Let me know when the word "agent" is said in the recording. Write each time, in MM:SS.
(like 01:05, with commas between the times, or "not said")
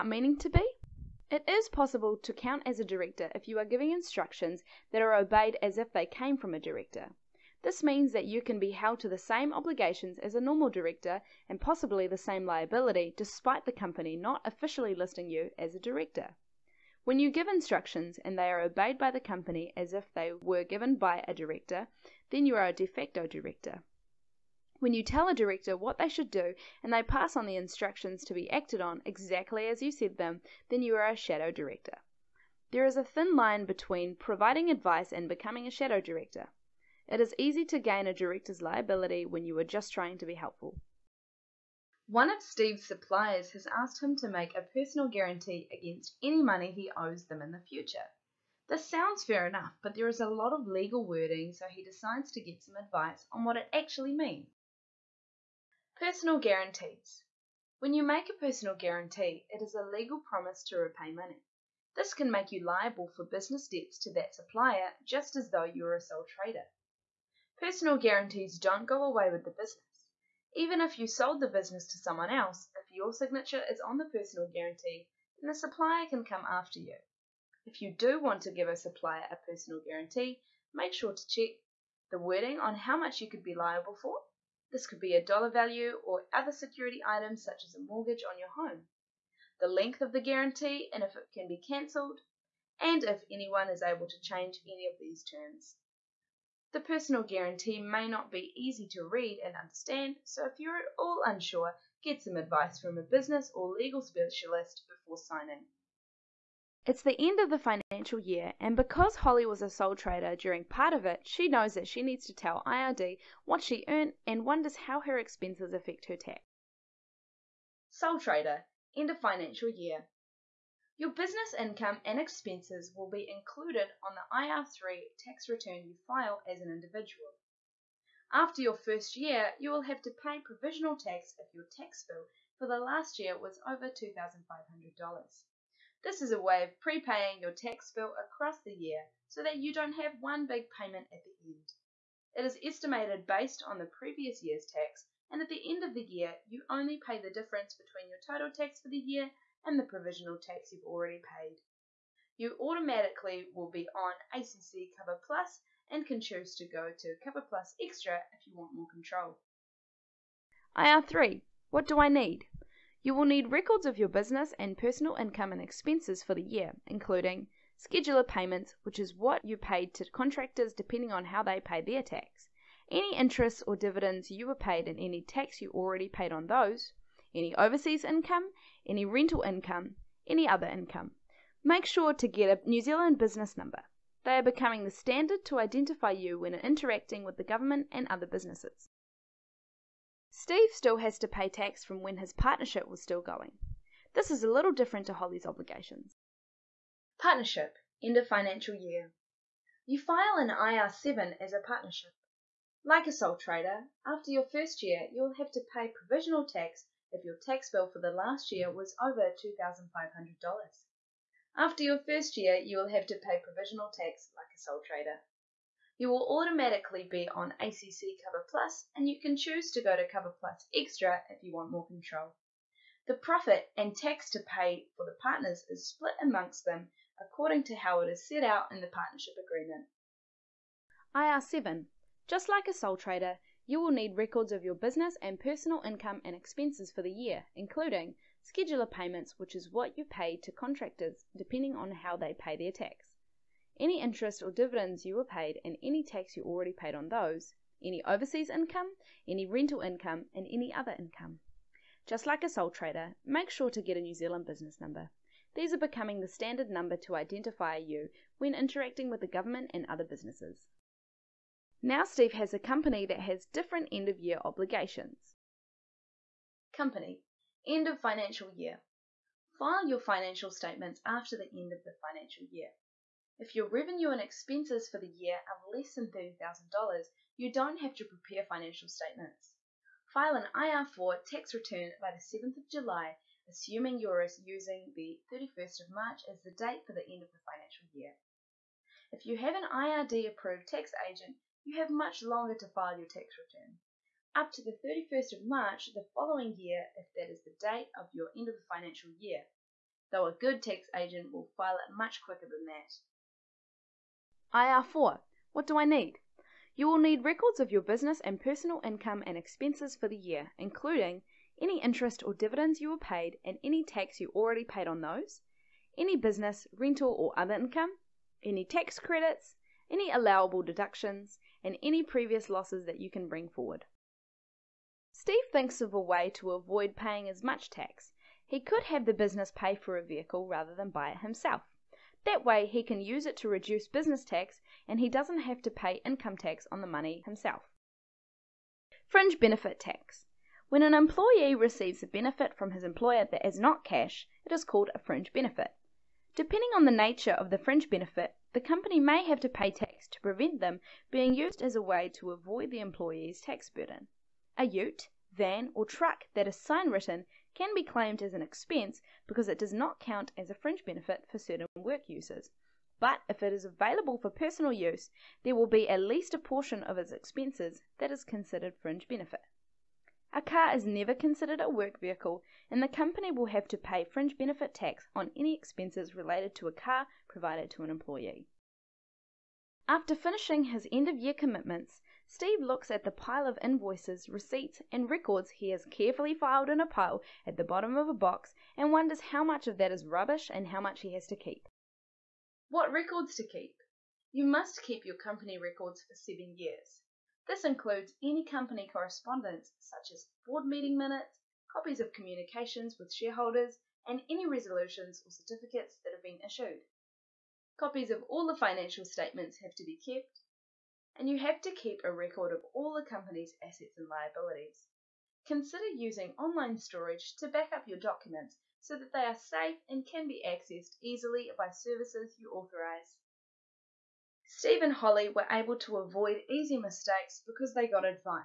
04:51, 05:00.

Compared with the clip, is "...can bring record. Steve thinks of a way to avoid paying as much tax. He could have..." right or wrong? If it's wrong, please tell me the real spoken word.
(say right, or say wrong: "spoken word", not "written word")
wrong: "forward", not "record".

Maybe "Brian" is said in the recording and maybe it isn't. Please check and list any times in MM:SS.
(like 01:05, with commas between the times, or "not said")
not said.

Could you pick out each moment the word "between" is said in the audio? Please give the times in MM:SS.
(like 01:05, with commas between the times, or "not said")
00:33, 02:27.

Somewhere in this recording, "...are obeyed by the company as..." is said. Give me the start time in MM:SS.
00:18.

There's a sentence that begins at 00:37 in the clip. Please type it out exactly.
It is easy to gain a director's liability when you are just trying to be helpful.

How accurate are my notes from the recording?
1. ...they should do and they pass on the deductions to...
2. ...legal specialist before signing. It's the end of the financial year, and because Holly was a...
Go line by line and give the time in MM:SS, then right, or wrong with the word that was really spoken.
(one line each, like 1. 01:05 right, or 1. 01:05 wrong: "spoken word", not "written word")
1. 00:25 wrong: "instructions", not "deductions"
2. 01:43 right.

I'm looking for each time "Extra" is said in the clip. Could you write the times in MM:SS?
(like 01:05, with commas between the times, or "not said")
02:37, 03:40.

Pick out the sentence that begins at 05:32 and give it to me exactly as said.
That way he can use it to reduce business tax and he doesn't have to pay income tax on the money himself.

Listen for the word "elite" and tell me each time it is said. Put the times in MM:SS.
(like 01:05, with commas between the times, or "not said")
not said.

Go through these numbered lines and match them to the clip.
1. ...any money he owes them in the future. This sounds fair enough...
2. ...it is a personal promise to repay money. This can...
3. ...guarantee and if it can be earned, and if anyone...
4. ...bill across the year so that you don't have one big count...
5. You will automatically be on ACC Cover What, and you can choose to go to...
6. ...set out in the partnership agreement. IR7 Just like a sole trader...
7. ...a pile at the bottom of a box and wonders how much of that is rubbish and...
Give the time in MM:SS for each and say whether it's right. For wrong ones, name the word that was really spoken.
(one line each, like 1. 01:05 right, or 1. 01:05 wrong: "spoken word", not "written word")
1. 00:46 right
2. 00:59 wrong: "legal", not "personal"
3. 01:30 wrong: "cancelled", not "earned"
4. 02:17 wrong: "payment", not "count"
5. 03:35 wrong: "Plus", not "What"
6. 03:48 right
7. 06:26 right.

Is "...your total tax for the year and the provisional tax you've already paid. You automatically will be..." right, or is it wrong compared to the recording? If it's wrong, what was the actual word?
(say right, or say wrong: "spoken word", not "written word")
right.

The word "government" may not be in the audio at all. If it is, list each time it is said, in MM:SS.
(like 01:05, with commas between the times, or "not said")
03:07, 04:19.